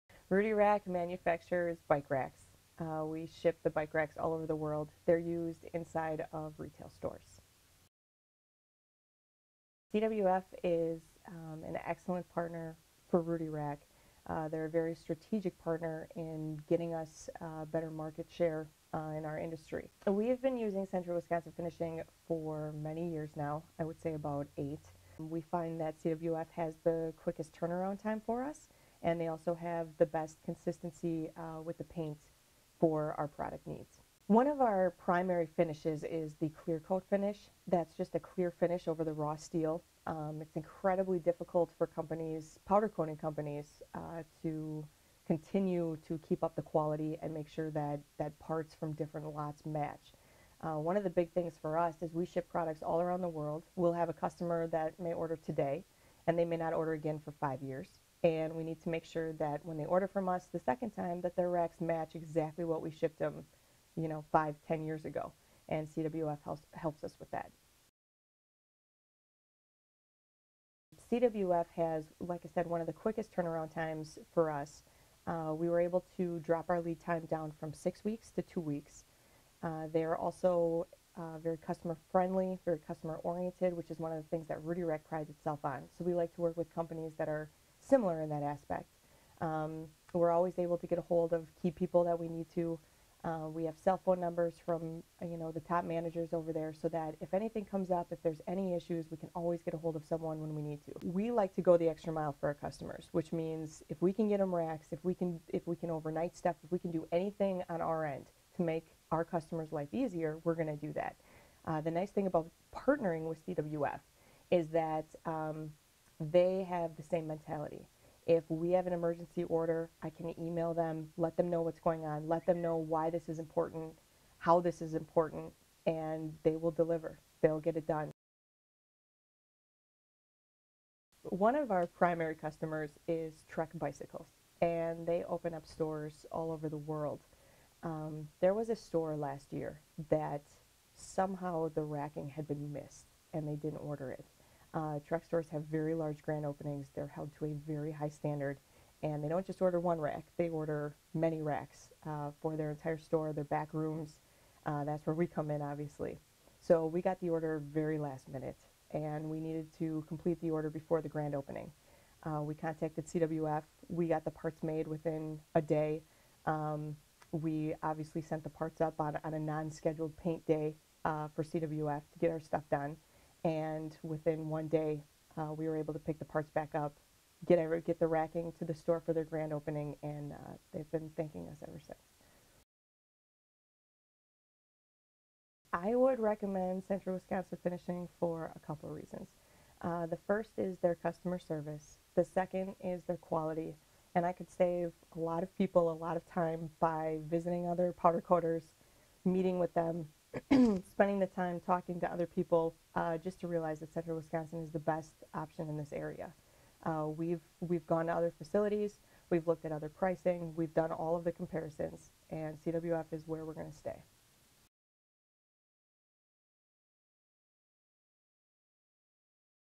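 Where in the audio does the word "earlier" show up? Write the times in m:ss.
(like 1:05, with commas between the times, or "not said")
not said.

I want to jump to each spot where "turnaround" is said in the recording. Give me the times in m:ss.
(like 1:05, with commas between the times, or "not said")
0:27, 1:13.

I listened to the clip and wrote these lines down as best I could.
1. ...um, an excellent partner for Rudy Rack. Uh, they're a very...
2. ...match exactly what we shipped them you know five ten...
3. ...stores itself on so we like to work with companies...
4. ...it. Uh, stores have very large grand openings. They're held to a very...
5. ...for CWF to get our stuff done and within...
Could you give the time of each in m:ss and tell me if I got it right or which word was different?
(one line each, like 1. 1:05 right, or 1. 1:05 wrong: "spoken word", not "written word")
1. 0:11 right
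2. 1:01 right
3. 1:25 wrong: "prides", not "stores"
4. 2:24 right
5. 2:51 right.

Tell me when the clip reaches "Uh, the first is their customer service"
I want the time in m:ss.
3:09.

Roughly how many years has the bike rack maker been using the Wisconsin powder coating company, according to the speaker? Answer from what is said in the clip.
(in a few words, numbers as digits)
8.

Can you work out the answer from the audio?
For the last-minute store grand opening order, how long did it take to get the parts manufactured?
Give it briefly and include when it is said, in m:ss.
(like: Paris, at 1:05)
Within a day, at 2:44.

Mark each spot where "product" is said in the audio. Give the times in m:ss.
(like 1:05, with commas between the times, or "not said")
0:33, 0:52.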